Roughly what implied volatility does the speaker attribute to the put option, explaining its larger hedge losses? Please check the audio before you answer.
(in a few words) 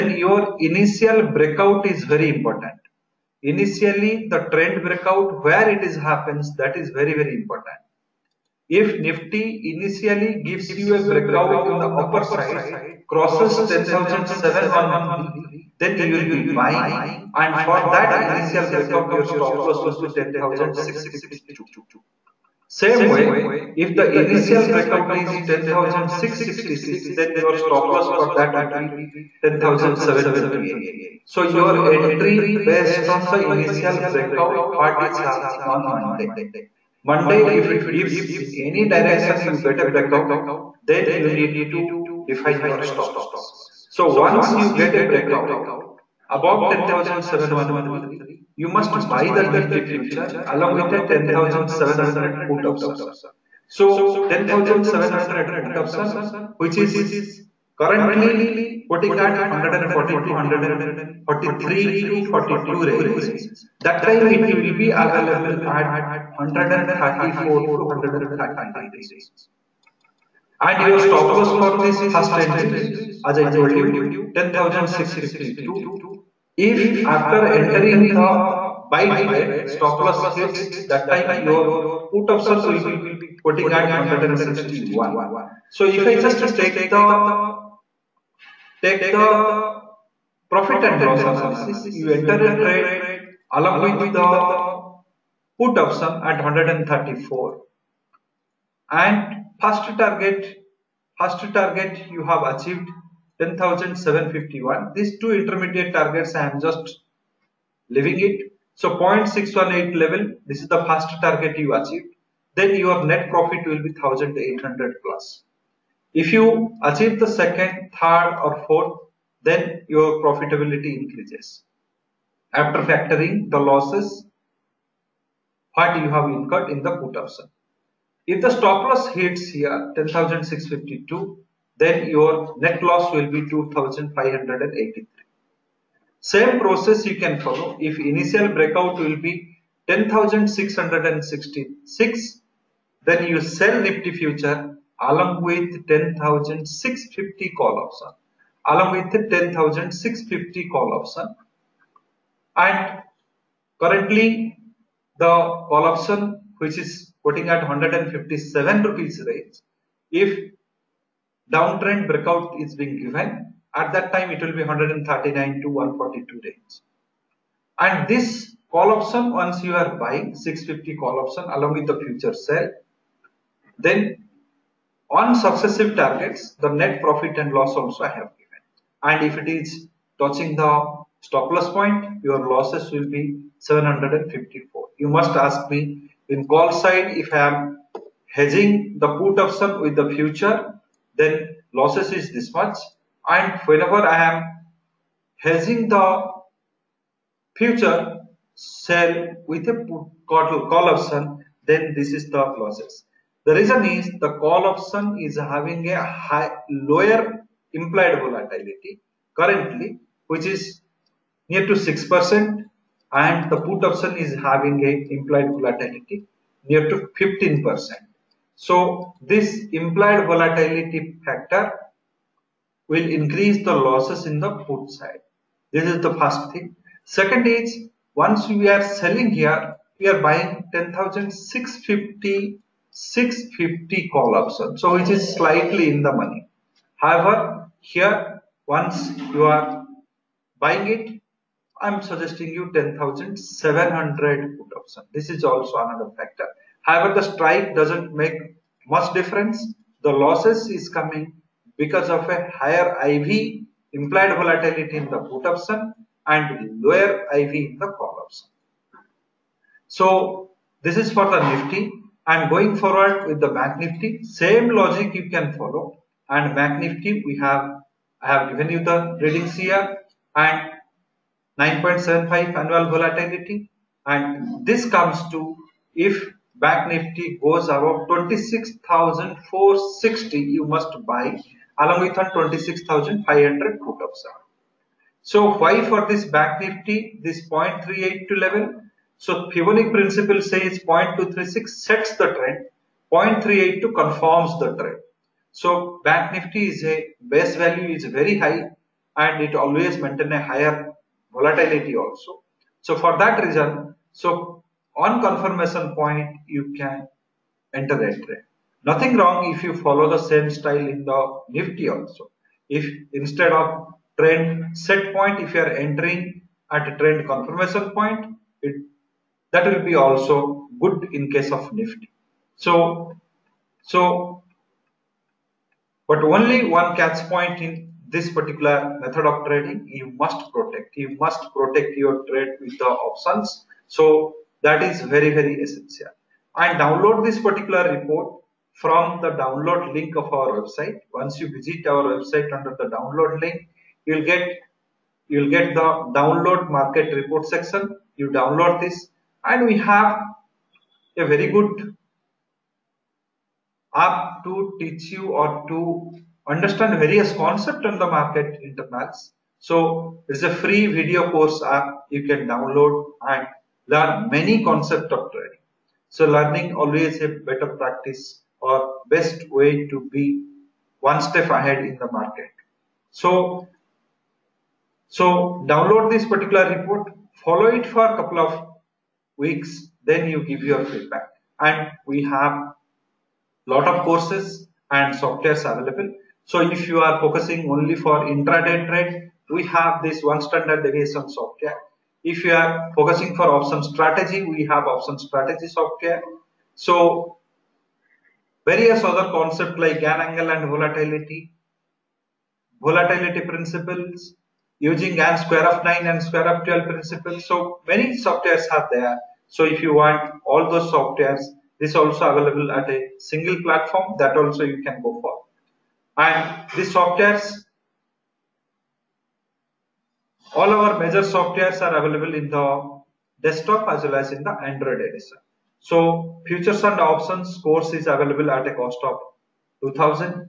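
15%.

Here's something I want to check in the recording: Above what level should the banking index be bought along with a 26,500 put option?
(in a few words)
26,460.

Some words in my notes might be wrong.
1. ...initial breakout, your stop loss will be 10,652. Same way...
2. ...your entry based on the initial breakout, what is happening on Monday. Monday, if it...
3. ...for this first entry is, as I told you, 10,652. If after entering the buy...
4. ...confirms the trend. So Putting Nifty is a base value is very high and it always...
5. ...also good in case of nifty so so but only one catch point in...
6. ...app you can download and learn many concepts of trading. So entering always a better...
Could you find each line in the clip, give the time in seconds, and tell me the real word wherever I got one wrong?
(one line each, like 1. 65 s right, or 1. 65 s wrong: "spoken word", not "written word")
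1. 18 s right
2. 31 s right
3. 71 s right
4. 293 s wrong: "Bank", not "Putting"
5. 319 s right
6. 361 s wrong: "learning", not "entering".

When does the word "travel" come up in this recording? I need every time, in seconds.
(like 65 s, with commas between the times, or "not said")
not said.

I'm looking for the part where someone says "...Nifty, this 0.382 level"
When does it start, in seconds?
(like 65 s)
286 s.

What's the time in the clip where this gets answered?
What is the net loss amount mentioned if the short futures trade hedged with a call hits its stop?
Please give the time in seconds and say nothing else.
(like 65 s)
183 s.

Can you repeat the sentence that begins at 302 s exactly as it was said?
So for that reason, so on confirmation point you can enter the entry.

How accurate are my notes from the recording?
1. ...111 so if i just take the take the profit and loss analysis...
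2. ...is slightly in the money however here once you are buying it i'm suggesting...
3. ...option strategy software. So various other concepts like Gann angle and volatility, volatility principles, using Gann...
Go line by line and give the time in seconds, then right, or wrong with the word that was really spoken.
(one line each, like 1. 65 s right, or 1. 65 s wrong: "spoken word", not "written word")
1. 83 s wrong: "161", not "111"
2. 235 s right
3. 394 s right.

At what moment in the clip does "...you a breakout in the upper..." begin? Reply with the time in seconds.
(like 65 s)
10 s.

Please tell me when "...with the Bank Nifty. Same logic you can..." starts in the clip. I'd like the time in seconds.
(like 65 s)
263 s.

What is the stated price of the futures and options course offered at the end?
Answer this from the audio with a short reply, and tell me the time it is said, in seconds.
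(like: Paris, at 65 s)
2000, at 429 s.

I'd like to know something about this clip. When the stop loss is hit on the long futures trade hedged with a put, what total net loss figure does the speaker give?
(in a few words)
2,583.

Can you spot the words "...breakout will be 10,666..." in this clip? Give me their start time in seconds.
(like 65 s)
138 s.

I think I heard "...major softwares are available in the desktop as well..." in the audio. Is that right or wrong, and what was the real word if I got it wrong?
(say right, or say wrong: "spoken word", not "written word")
right.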